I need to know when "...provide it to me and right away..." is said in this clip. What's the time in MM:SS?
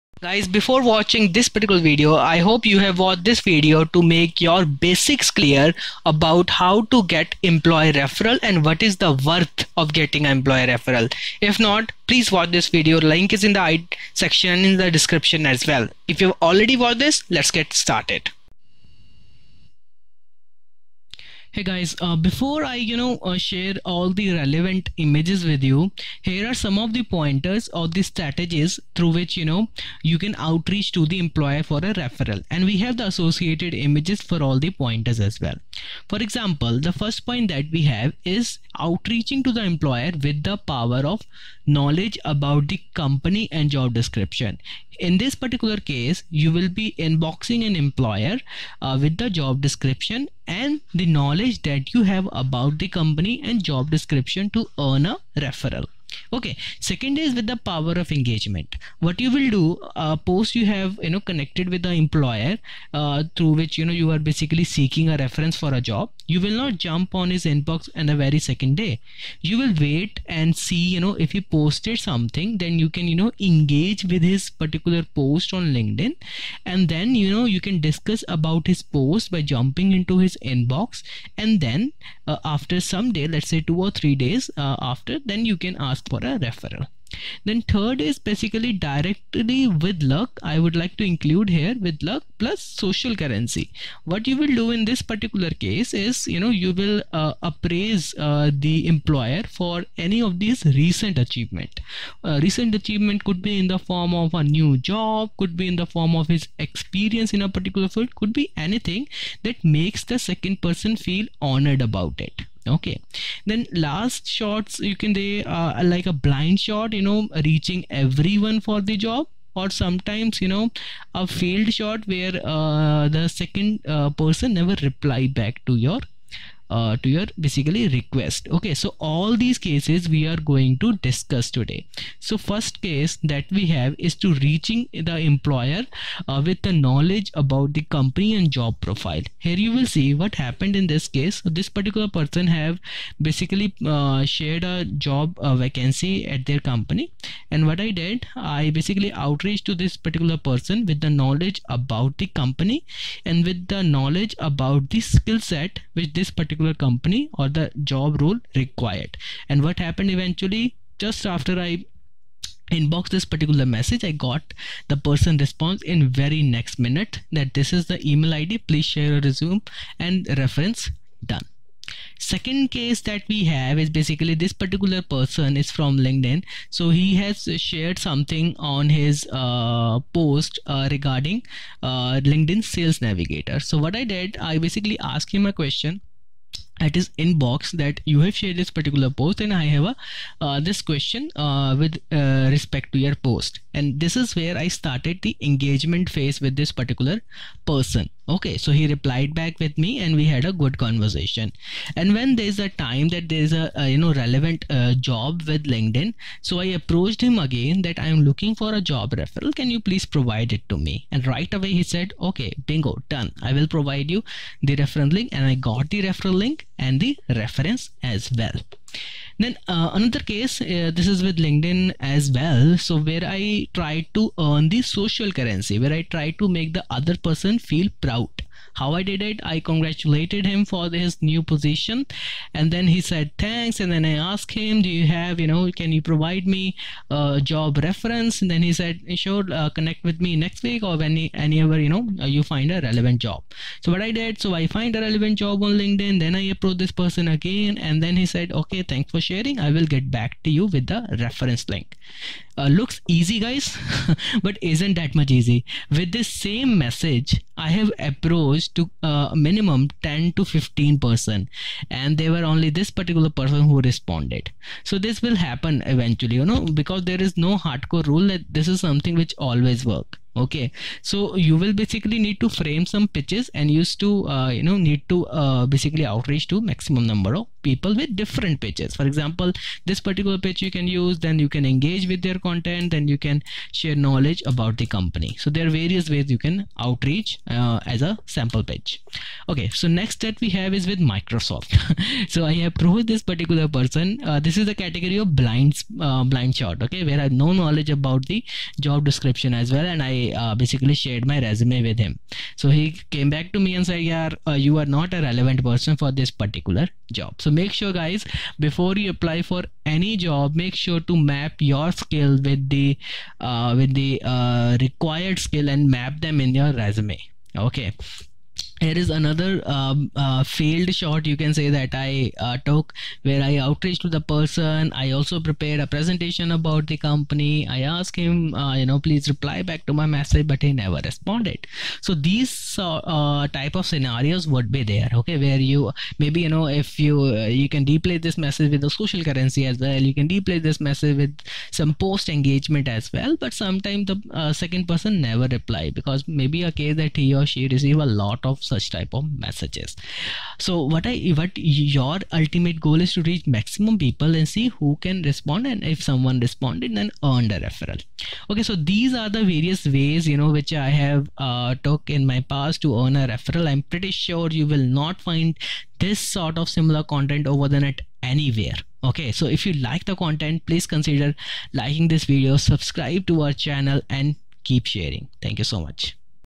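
03:30.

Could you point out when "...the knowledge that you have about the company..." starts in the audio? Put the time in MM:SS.
00:50.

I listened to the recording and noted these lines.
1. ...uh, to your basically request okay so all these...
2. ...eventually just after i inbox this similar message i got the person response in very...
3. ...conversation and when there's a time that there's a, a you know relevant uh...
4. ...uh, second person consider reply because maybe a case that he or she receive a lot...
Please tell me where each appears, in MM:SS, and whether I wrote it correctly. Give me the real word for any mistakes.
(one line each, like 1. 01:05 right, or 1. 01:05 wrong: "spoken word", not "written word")
1. 02:06 right
2. 02:40 wrong: "particular", not "similar"
3. 03:20 right
4. 05:44 wrong: "never", not "consider".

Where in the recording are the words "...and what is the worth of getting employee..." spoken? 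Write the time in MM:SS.
00:08.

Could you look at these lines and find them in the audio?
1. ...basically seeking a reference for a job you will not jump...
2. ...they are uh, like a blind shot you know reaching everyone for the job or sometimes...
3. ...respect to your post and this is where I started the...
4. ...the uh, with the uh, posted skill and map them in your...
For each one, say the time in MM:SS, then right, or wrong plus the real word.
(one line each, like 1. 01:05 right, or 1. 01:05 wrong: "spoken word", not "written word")
1. 01:04 right
2. 01:55 right
3. 03:12 right
4. 05:12 wrong: "required", not "posted".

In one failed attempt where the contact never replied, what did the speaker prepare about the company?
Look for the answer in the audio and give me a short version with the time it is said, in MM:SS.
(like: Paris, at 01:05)
a presentation, at 05:25.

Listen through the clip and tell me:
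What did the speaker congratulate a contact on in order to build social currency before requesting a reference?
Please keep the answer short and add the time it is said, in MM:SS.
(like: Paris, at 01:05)
his new position, at 03:51.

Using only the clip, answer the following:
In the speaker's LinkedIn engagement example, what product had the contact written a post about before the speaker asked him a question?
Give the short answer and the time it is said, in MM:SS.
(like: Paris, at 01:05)
LinkedIn Sales Navigator, at 03:02.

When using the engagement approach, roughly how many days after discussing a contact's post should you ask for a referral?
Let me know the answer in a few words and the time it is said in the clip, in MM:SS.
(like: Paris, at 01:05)
2 or 3, at 01:23.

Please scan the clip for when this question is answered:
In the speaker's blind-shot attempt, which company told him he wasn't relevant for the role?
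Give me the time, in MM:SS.
04:50.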